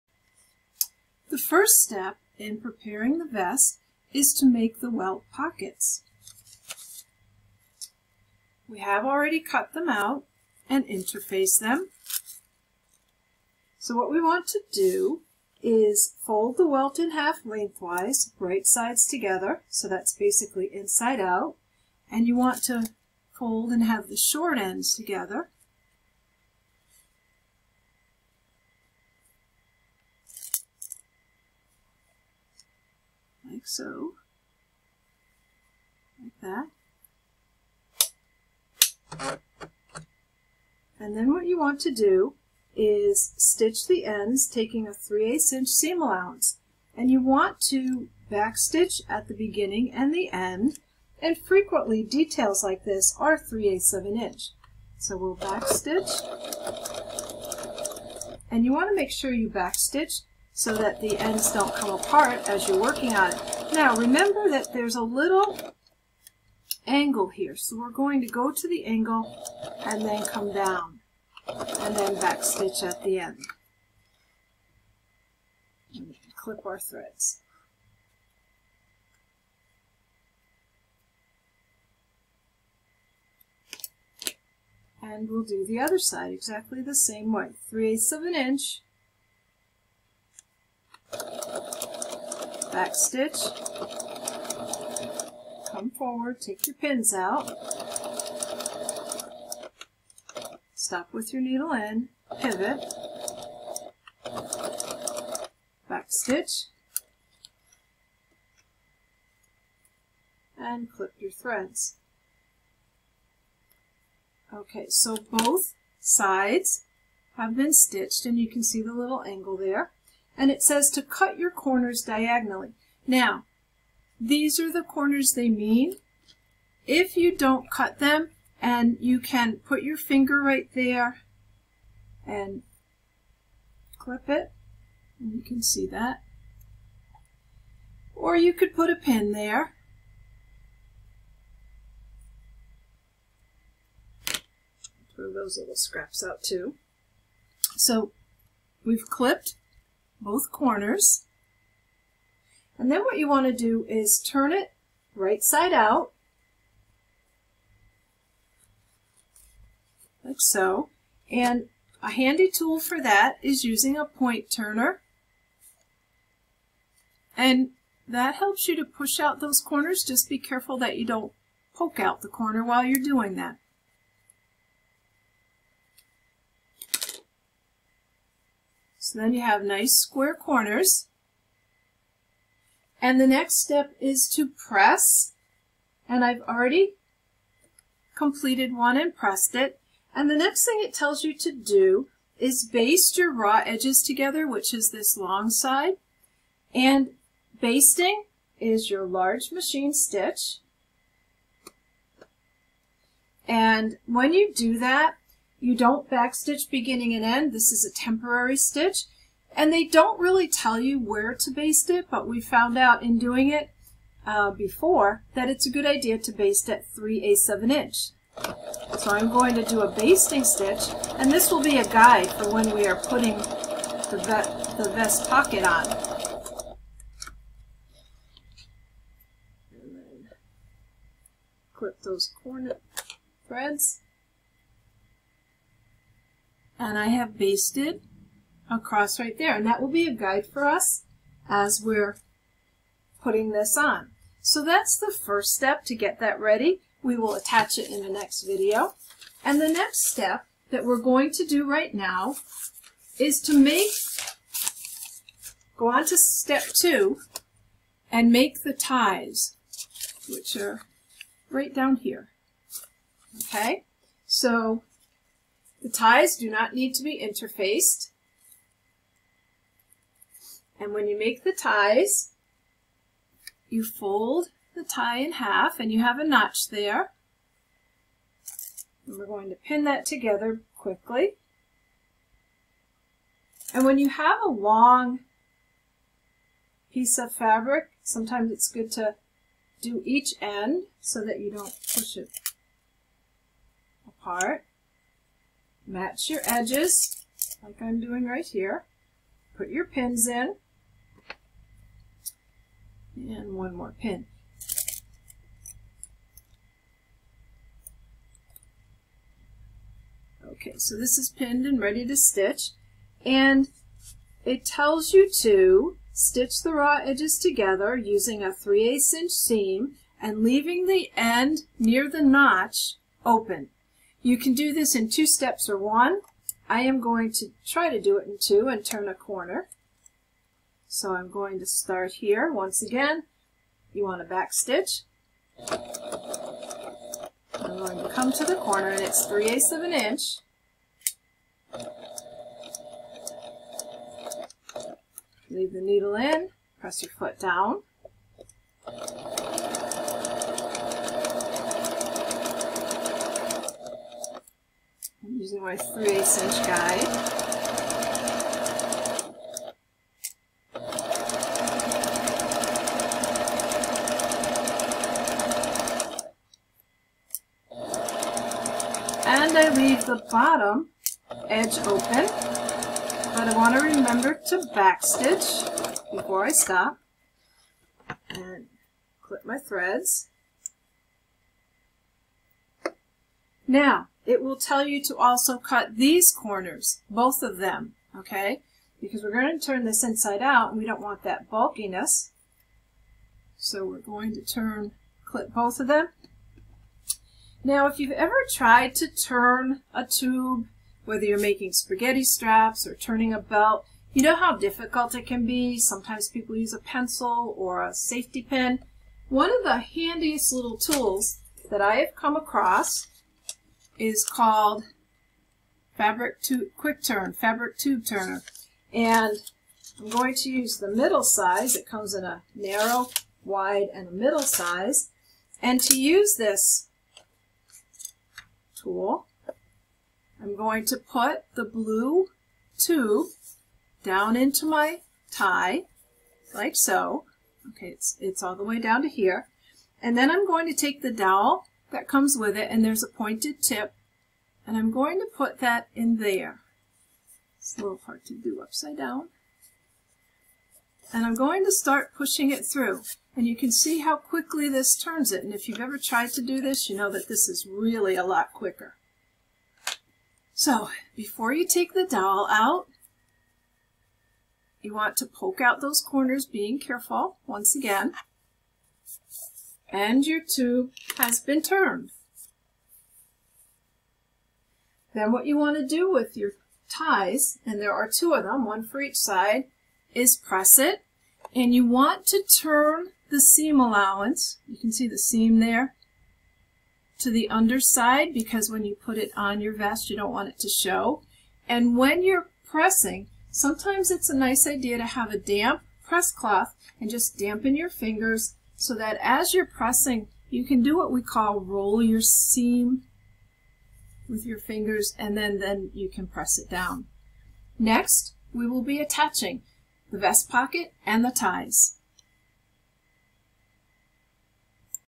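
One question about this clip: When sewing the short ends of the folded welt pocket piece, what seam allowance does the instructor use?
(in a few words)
3/8 inch.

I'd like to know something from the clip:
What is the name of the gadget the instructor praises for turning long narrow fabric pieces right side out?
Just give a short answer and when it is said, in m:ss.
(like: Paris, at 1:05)
Quick Turn fabric tube turner, at 6:56.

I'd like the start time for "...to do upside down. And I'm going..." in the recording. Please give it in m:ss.
7:28.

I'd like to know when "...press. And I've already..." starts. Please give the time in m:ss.
3:04.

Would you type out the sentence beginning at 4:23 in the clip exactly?
Okay, so the ties do not need to be interfaced.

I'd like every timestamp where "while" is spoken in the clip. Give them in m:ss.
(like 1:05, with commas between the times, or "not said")
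2:52.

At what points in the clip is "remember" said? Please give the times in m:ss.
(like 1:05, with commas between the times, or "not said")
1:03, 6:13.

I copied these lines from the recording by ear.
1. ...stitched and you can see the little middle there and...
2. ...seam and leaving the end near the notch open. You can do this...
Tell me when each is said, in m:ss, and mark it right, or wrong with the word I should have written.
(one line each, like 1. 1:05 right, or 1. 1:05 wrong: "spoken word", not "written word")
1. 1:57 wrong: "angle", not "middle"
2. 5:19 right.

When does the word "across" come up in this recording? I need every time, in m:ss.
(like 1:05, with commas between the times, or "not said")
3:58, 6:52.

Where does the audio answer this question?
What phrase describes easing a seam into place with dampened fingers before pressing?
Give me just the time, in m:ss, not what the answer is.
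8:21.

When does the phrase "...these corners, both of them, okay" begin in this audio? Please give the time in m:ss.
6:25.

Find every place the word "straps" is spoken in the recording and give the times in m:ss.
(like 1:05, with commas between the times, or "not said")
6:42.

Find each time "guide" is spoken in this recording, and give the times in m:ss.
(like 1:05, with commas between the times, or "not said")
3:41, 4:00, 5:56.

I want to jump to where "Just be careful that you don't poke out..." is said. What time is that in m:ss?
2:50.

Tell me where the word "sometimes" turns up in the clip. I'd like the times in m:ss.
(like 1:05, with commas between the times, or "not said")
4:48, 6:45, 8:13.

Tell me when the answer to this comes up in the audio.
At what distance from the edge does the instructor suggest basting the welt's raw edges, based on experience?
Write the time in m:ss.
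3:36.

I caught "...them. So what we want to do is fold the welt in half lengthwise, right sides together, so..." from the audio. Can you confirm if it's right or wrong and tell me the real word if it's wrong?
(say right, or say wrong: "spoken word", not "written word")
right.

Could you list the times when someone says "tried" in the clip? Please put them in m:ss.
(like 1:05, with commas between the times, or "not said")
6:38, 7:36.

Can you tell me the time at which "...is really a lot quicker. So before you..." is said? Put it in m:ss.
7:37.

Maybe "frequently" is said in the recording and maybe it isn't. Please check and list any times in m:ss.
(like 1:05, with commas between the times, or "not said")
0:51.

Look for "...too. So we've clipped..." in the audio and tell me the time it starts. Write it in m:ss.
2:26.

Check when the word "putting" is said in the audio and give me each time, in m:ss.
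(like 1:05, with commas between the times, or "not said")
3:42, 4:03.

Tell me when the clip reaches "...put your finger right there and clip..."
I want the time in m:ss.
2:09.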